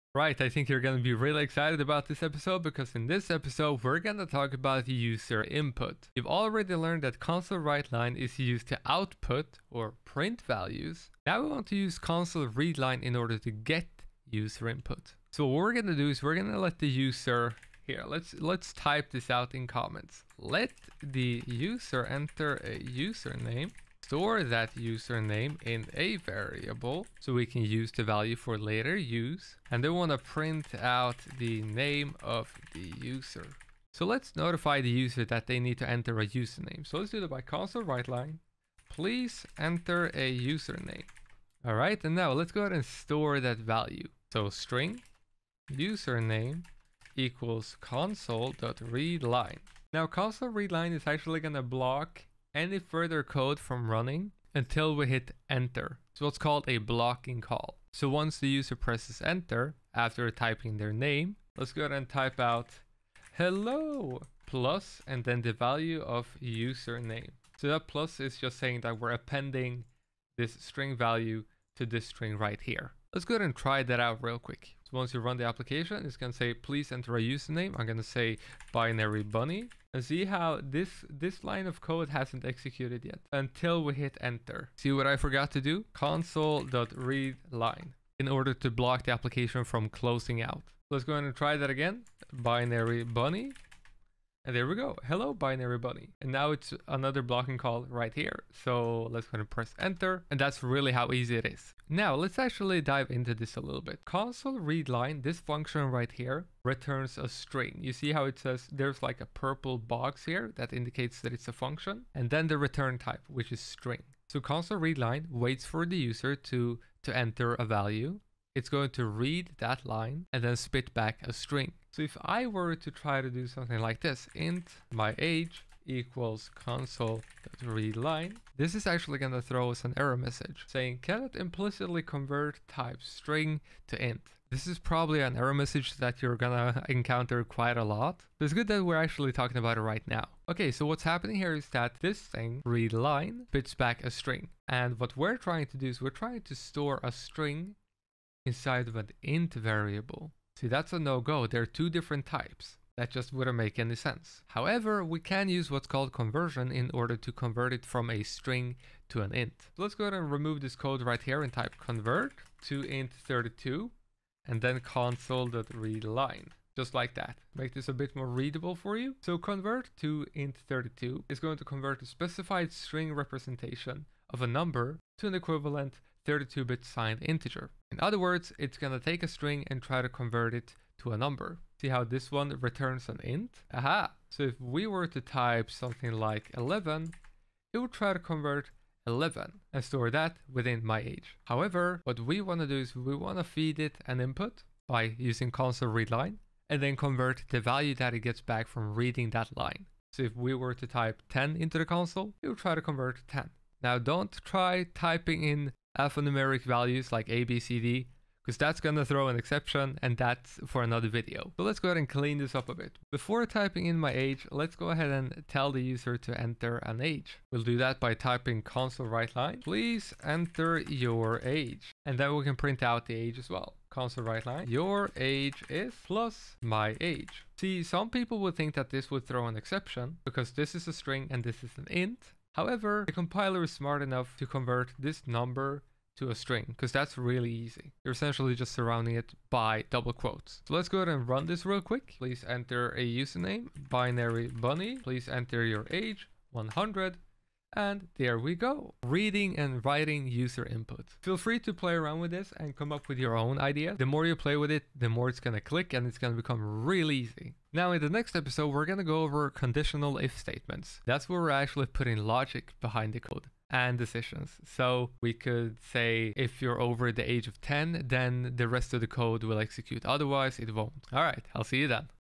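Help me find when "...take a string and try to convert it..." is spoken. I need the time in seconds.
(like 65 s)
178 s.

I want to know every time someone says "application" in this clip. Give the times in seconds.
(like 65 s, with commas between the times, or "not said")
75 s, 89 s.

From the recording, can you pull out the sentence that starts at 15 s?
So what we're going to do is we're going to let the user here.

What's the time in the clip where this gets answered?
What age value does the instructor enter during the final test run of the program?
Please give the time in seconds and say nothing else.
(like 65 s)
246 s.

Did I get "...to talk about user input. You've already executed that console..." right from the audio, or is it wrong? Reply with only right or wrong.
wrong.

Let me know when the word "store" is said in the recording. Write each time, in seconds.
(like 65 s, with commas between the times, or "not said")
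24 s, 42 s, 146 s, 189 s.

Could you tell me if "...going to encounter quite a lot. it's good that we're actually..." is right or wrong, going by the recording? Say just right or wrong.
right.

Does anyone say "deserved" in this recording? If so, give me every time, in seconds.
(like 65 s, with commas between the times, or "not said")
not said.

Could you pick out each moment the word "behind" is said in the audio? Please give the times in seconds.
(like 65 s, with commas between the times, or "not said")
262 s.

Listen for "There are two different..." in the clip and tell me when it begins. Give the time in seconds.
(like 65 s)
151 s.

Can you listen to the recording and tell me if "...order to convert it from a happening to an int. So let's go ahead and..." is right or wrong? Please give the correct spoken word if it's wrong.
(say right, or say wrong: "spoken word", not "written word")
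wrong: "string", not "happening".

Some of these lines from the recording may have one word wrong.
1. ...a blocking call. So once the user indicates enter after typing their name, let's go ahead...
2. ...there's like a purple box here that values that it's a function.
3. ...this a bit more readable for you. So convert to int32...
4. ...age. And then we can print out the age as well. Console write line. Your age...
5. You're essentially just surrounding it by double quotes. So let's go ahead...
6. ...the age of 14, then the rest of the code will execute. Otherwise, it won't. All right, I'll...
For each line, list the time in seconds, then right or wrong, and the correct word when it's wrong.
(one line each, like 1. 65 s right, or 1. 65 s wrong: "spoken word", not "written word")
1. 56 s wrong: "presses", not "indicates"
2. 108 s wrong: "indicates", not "values"
3. 167 s right
4. 221 s right
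5. 238 s right
6. 267 s wrong: "10", not "14".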